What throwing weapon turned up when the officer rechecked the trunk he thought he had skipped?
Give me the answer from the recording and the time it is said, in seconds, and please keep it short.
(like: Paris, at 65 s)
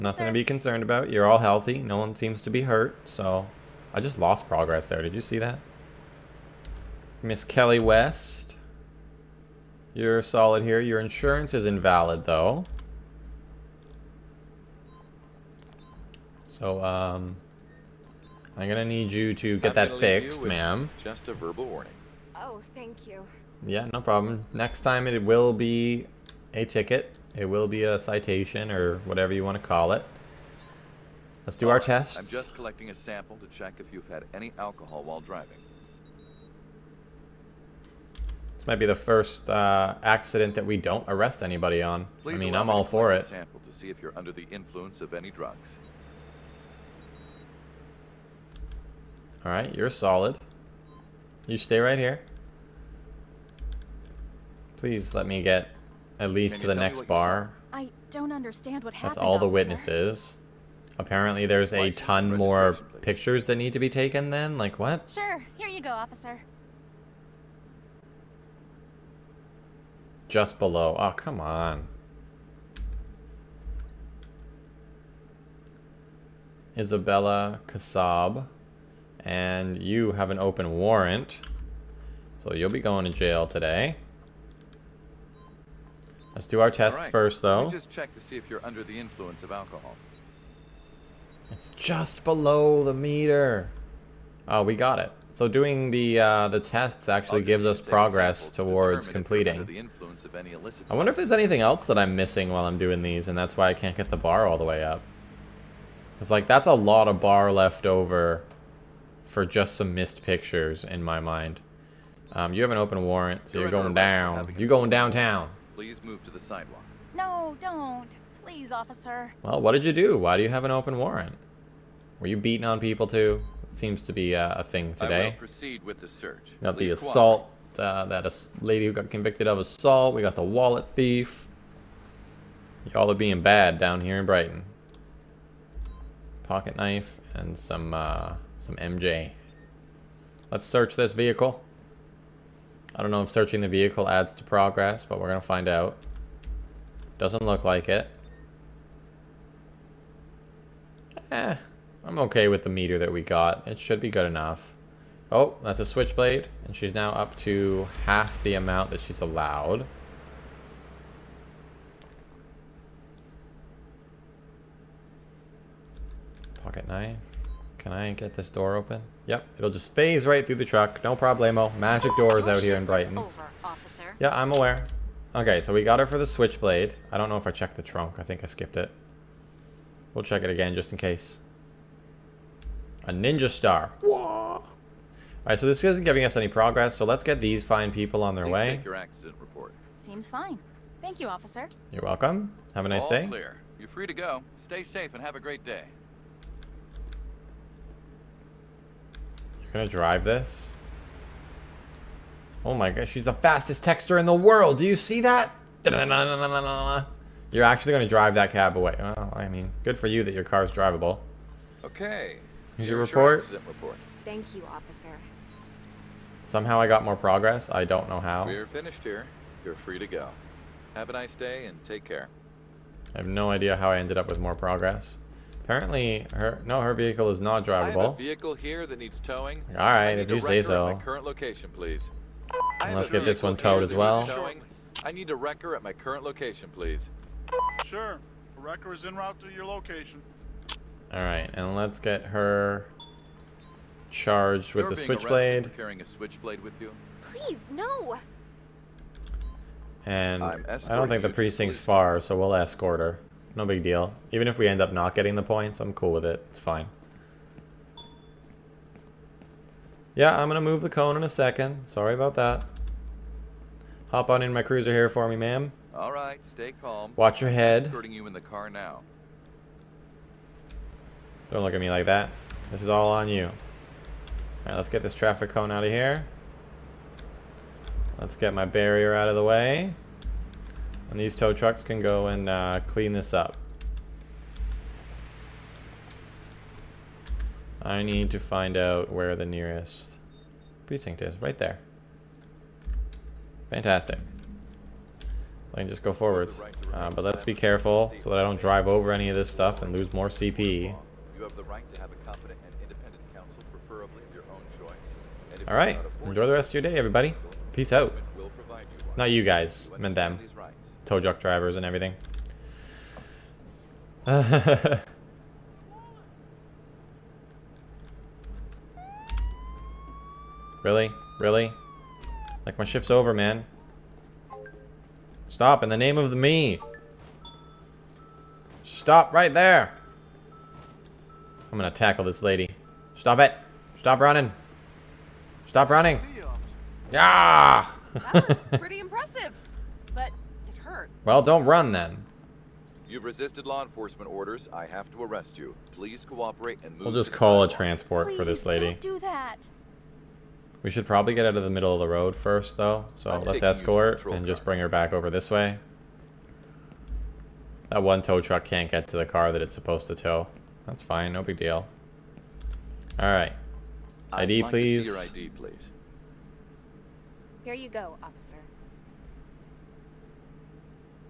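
Ninja star, at 183 s.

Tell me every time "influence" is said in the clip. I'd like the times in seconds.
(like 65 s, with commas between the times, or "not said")
44 s, 88 s.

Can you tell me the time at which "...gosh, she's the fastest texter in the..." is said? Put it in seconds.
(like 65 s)
202 s.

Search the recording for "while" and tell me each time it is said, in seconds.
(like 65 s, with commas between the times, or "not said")
35 s, 102 s.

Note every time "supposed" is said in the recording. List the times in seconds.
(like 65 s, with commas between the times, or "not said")
359 s.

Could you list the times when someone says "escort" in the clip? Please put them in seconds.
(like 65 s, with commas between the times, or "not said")
252 s, 353 s.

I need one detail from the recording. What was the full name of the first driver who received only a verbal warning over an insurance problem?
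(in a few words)
Kelly West.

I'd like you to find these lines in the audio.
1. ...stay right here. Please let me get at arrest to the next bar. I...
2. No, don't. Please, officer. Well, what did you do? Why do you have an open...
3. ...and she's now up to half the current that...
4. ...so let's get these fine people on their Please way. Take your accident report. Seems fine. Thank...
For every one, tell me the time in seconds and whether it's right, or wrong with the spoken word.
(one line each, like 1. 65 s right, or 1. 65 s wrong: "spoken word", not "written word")
1. 51 s wrong: "least", not "arrest"
2. 117 s right
3. 156 s wrong: "amount", not "current"
4. 186 s right.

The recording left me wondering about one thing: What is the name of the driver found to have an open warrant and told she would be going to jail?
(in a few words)
Isabella Kasab.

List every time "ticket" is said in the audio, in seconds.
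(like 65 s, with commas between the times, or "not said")
26 s.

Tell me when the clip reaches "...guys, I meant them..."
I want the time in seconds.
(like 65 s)
309 s.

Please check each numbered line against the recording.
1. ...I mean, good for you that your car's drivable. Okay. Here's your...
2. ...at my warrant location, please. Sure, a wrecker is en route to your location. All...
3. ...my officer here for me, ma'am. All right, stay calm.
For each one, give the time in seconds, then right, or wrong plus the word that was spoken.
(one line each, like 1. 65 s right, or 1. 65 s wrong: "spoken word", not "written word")
1. 209 s right
2. 235 s wrong: "current", not "warrant"
3. 264 s wrong: "cruiser", not "officer".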